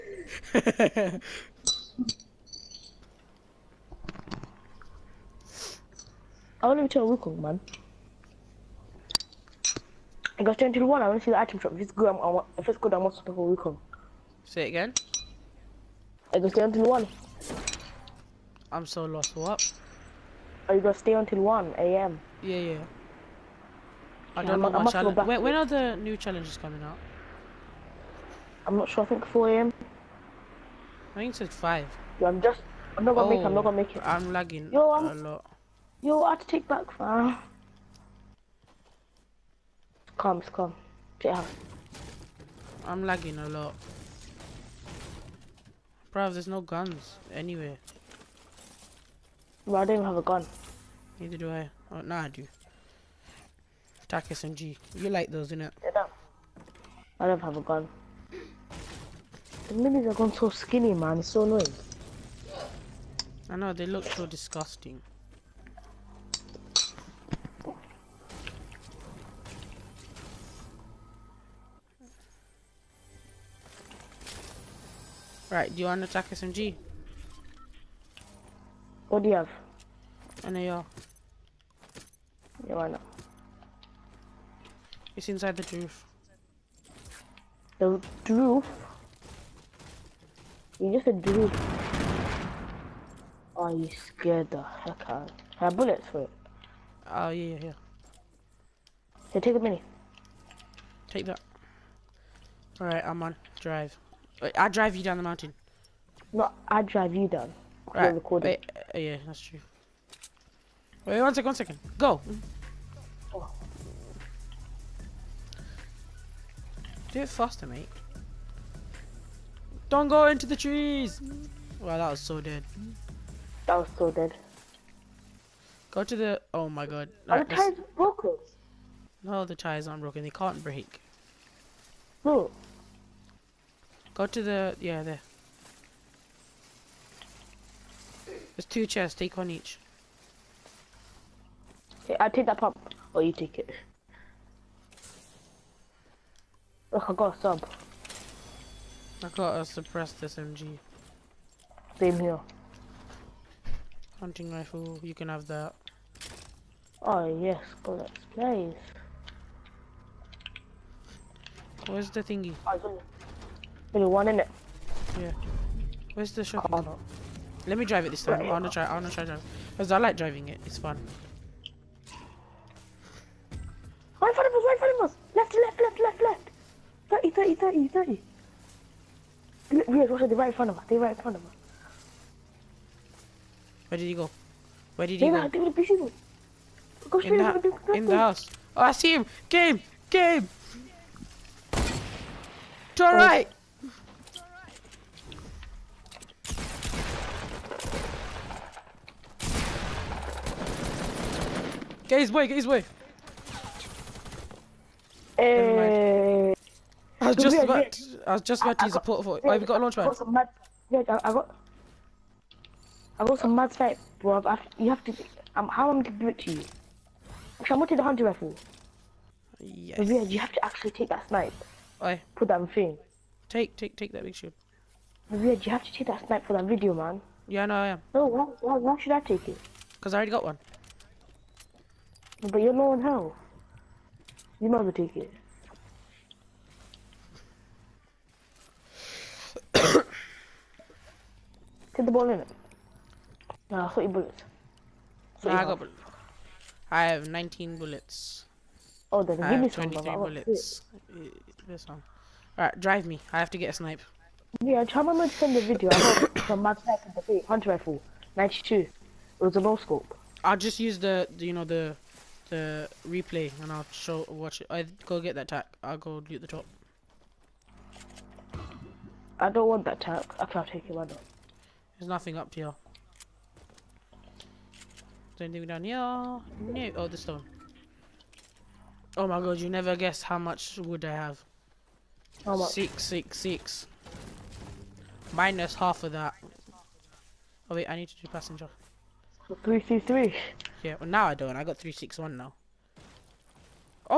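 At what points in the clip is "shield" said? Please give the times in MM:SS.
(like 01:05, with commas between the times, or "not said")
03:44.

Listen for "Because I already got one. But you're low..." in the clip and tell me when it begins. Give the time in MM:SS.
03:49.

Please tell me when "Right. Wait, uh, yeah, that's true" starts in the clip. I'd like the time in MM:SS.
01:47.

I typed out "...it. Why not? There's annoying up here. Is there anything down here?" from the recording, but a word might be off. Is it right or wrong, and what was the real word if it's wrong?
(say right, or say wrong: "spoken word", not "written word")
wrong: "nothing", not "annoying".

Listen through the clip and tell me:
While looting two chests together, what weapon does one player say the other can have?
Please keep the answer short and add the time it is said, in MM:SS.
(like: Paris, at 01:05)
Hunting rifle, at 02:34.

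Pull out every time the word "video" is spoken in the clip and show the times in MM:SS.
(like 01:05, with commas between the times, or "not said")
03:46, 04:15.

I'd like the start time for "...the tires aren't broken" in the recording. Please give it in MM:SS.
02:09.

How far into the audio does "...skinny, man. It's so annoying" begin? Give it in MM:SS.
01:00.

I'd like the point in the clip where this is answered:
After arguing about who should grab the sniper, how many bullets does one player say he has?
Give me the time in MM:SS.
04:07.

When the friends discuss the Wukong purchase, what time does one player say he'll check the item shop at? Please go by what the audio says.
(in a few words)
10 to 1.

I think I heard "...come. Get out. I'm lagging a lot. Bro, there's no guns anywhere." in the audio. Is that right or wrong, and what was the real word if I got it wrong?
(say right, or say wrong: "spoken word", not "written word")
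right.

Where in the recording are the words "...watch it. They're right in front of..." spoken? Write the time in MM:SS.
03:00.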